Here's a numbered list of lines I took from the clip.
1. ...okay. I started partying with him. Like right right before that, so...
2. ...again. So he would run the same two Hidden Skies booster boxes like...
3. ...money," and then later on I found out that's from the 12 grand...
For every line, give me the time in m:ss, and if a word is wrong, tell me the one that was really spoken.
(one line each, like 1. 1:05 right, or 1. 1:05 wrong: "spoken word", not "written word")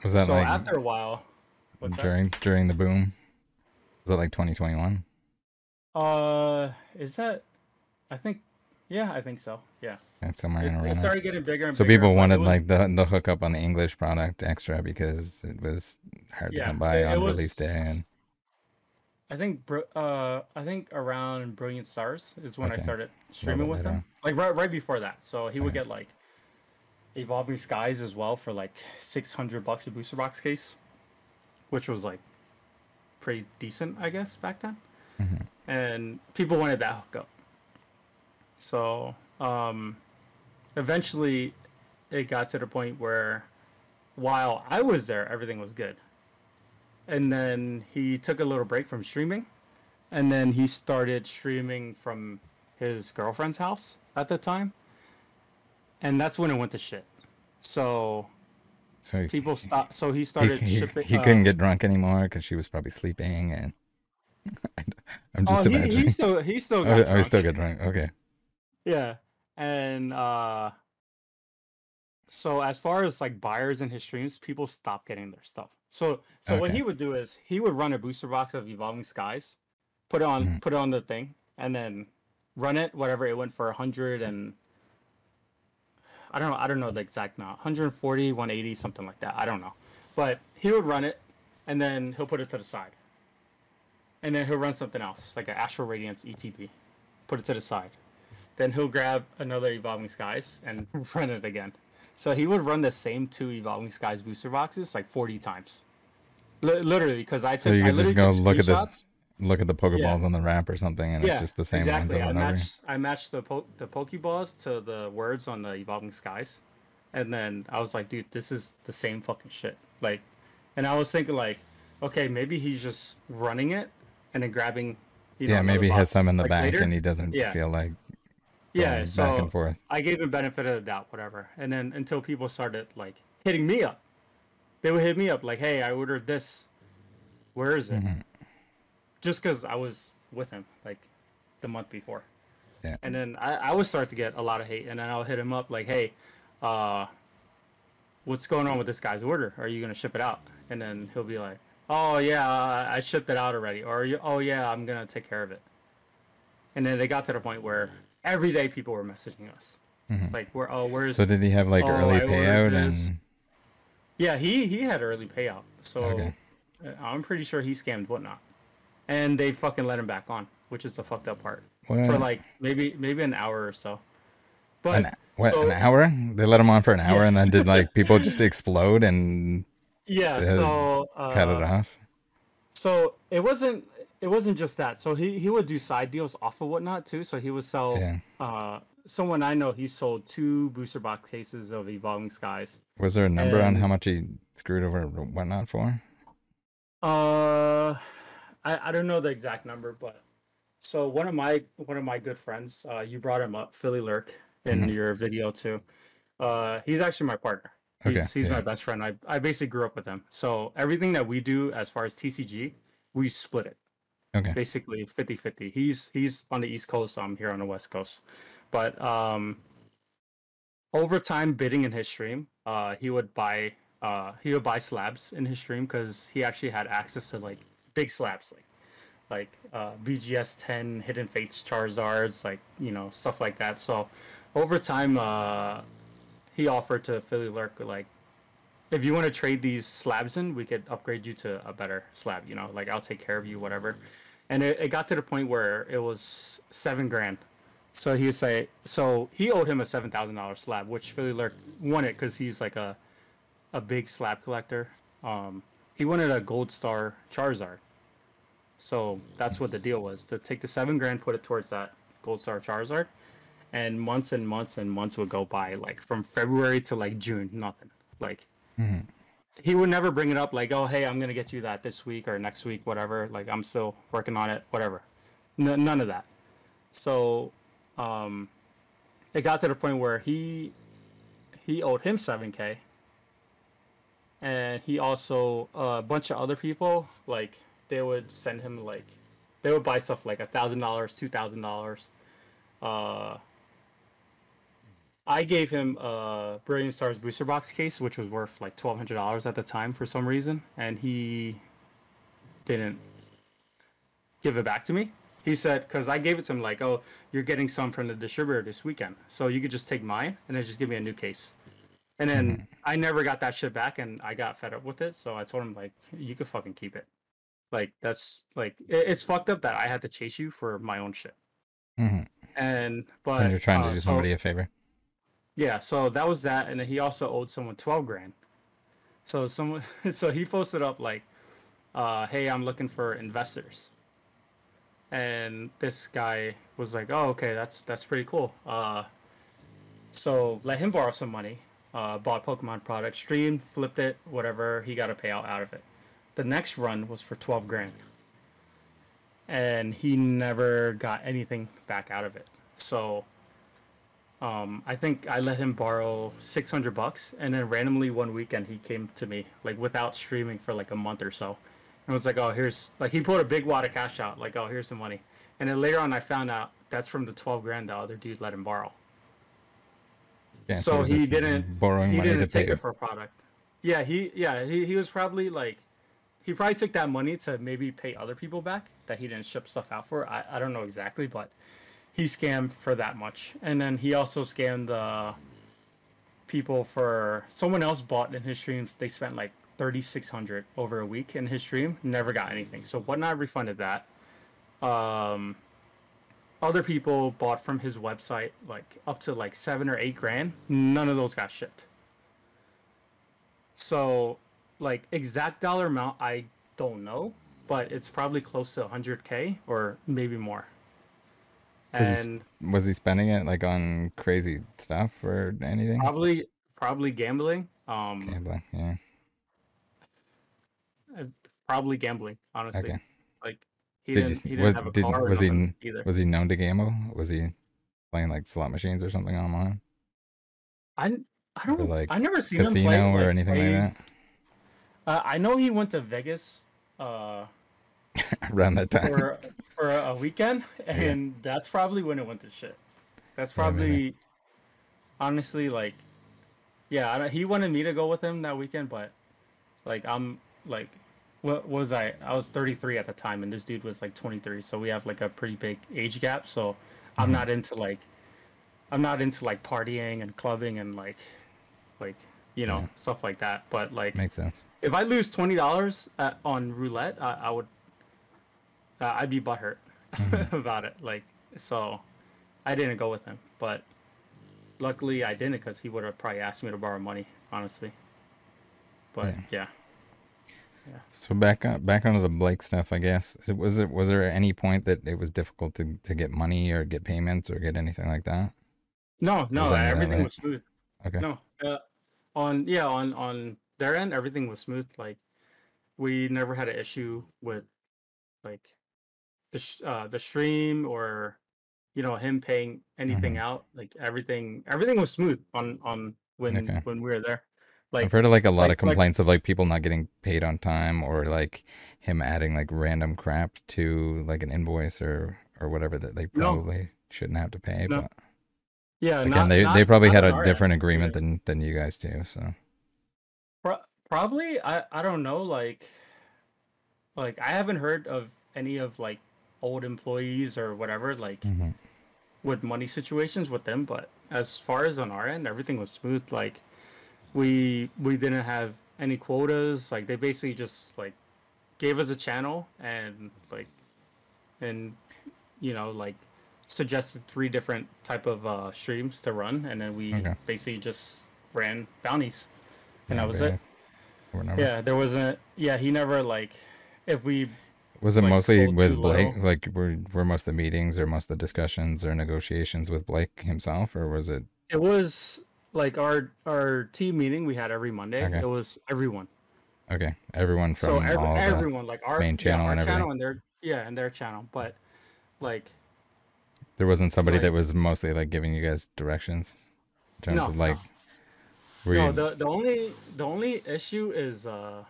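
1. 0:22 wrong: "streaming", not "partying"
2. 1:41 wrong: "Evolving", not "Hidden"
3. 6:04 right.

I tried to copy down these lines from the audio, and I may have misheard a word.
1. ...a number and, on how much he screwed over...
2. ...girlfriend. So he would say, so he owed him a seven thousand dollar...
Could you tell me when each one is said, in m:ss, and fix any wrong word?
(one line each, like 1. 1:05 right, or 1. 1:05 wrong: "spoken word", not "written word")
1. 3:13 right
2. 4:07 wrong: "grand", not "girlfriend".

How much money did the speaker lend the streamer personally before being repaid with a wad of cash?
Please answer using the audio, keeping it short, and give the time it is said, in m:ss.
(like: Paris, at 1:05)
$600, at 5:56.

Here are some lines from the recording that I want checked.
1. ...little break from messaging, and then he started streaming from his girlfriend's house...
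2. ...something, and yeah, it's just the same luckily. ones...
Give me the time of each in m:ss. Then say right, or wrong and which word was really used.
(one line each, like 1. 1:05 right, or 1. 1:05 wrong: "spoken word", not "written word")
1. 0:48 wrong: "streaming", not "messaging"
2. 1:50 wrong: "exactly", not "luckily".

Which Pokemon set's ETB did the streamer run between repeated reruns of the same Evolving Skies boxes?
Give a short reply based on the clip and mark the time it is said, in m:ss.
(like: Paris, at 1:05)
Astral Radiance, at 1:35.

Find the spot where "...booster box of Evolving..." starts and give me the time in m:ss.
1:17.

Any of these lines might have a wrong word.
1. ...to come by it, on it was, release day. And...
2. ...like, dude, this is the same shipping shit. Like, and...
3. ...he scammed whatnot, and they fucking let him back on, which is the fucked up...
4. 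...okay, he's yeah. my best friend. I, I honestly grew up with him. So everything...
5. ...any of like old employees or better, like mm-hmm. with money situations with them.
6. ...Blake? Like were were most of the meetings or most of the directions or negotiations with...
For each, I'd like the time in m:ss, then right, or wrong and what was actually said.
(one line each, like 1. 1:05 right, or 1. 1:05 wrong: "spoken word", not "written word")
1. 0:16 right
2. 1:57 wrong: "fucking", not "shipping"
3. 2:47 right
4. 3:28 wrong: "basically", not "honestly"
5. 8:48 wrong: "whatever", not "better"
6. 9:18 wrong: "discussions", not "directions".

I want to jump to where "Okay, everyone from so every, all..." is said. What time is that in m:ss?
9:29.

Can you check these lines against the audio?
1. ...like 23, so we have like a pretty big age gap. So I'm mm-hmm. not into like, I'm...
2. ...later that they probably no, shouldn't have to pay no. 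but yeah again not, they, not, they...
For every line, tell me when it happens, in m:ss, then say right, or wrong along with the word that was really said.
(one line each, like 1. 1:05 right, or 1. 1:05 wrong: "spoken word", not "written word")
1. 7:34 right
2. 8:35 wrong: "whatever", not "later".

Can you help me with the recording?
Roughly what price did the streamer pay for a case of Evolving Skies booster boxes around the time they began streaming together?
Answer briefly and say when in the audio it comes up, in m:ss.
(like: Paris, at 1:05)
600 bucks, at 0:28.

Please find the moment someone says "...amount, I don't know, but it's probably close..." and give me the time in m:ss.
6:45.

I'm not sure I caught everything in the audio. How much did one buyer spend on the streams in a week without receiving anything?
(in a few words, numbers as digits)
$3,600.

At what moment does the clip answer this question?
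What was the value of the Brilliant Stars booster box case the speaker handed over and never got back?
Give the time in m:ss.
4:58.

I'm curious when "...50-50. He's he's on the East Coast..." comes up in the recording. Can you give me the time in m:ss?
3:35.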